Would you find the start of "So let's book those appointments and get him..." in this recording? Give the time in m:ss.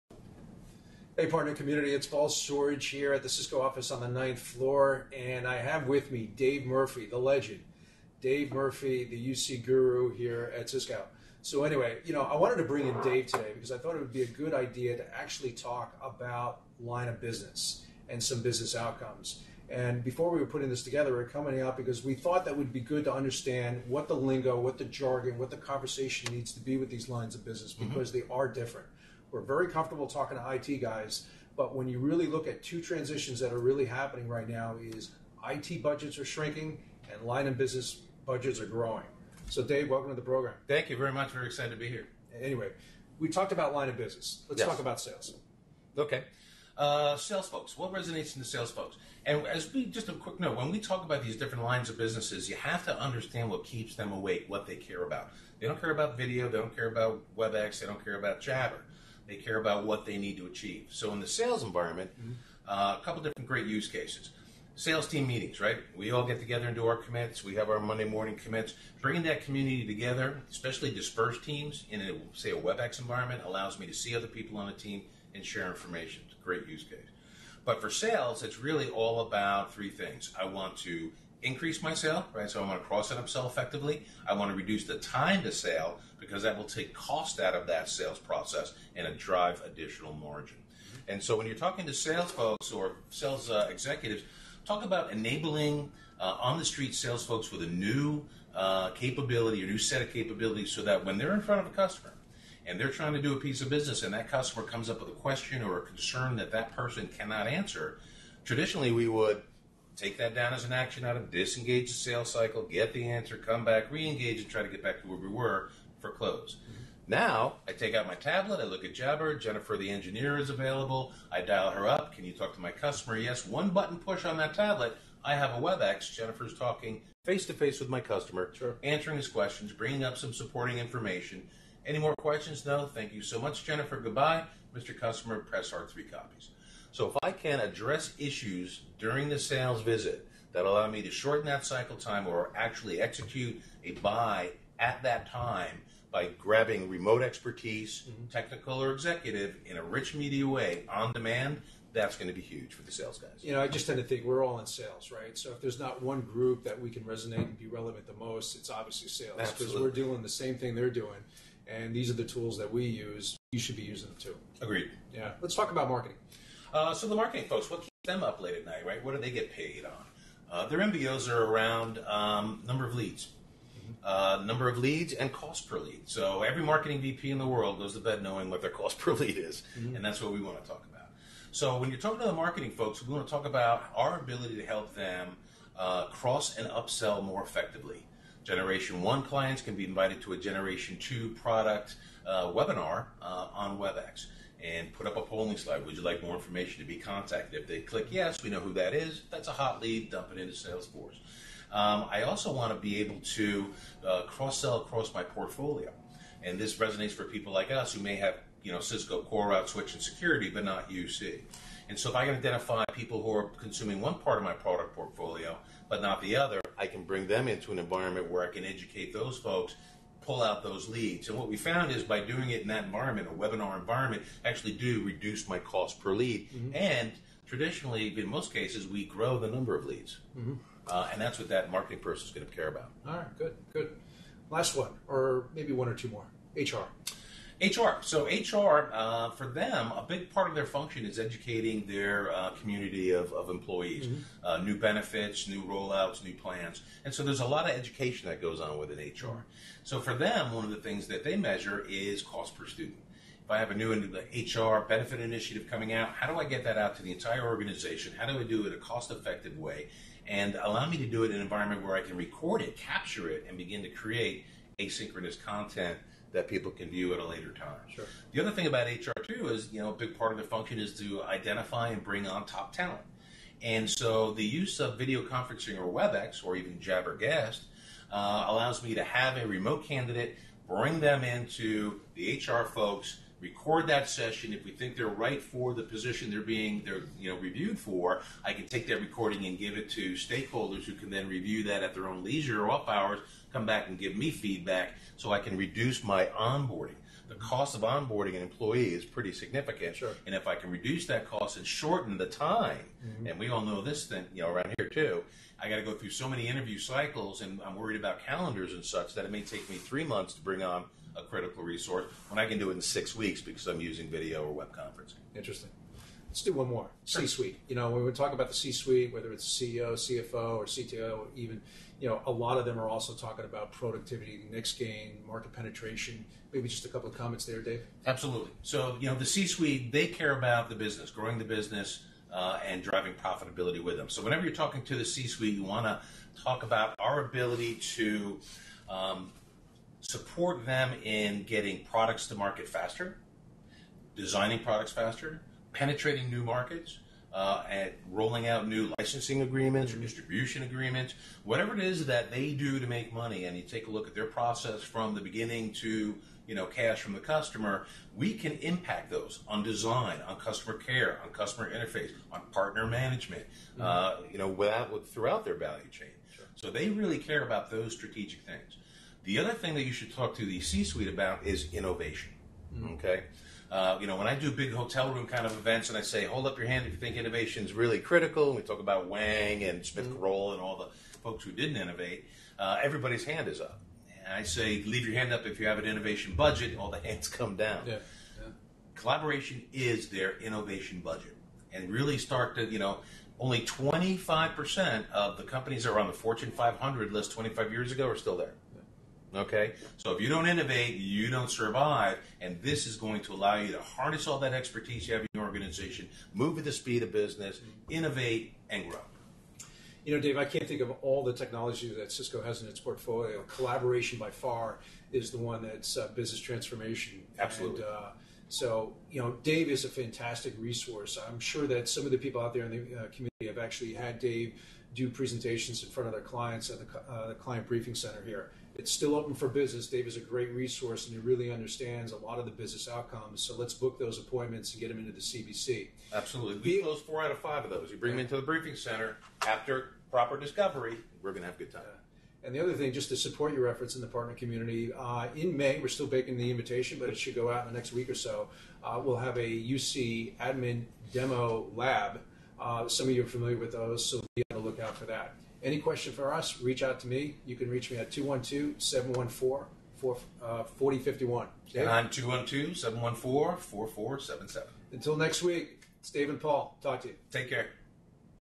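7:13.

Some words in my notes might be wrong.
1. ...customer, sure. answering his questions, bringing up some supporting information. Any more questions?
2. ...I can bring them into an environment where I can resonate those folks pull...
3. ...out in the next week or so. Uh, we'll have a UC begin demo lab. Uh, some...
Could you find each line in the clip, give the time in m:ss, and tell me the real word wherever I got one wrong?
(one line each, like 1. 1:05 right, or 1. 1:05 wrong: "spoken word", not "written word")
1. 2:07 right
2. 3:36 wrong: "educate", not "resonate"
3. 7:27 wrong: "admin", not "begin".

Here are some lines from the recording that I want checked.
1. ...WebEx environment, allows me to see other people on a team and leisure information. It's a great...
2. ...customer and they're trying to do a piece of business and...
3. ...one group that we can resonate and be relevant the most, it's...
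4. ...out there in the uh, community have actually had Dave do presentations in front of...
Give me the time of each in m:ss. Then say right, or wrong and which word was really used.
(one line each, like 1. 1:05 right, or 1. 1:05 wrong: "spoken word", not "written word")
1. 1:12 wrong: "share", not "leisure"
2. 1:41 right
3. 2:36 right
4. 7:02 right.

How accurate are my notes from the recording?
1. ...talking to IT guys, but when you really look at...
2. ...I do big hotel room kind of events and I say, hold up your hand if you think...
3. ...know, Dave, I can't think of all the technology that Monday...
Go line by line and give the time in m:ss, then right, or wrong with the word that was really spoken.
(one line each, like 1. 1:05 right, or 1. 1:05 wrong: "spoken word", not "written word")
1. 0:30 right
2. 6:14 right
3. 6:50 wrong: "Cisco", not "Monday".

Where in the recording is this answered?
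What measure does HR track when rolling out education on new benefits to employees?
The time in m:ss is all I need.
4:12.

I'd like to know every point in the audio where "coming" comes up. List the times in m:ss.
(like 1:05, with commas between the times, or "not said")
0:21, 4:15.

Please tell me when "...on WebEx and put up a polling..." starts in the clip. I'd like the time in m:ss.
3:13.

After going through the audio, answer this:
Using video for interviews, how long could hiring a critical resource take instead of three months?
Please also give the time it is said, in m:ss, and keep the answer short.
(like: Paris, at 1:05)
6 weeks, at 5:12.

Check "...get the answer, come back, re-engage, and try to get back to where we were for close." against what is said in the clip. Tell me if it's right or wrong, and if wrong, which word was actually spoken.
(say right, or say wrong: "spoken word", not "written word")
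right.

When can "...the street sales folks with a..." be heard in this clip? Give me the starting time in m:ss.
1:36.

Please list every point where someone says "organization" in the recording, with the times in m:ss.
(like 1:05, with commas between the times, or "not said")
4:17, 6:45.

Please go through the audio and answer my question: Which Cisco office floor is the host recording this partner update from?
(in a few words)
Ninth floor.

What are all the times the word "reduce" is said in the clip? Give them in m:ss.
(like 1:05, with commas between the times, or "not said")
1:24, 3:45, 4:55, 5:00.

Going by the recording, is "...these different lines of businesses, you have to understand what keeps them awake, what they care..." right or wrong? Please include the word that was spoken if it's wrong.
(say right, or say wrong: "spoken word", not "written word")
right.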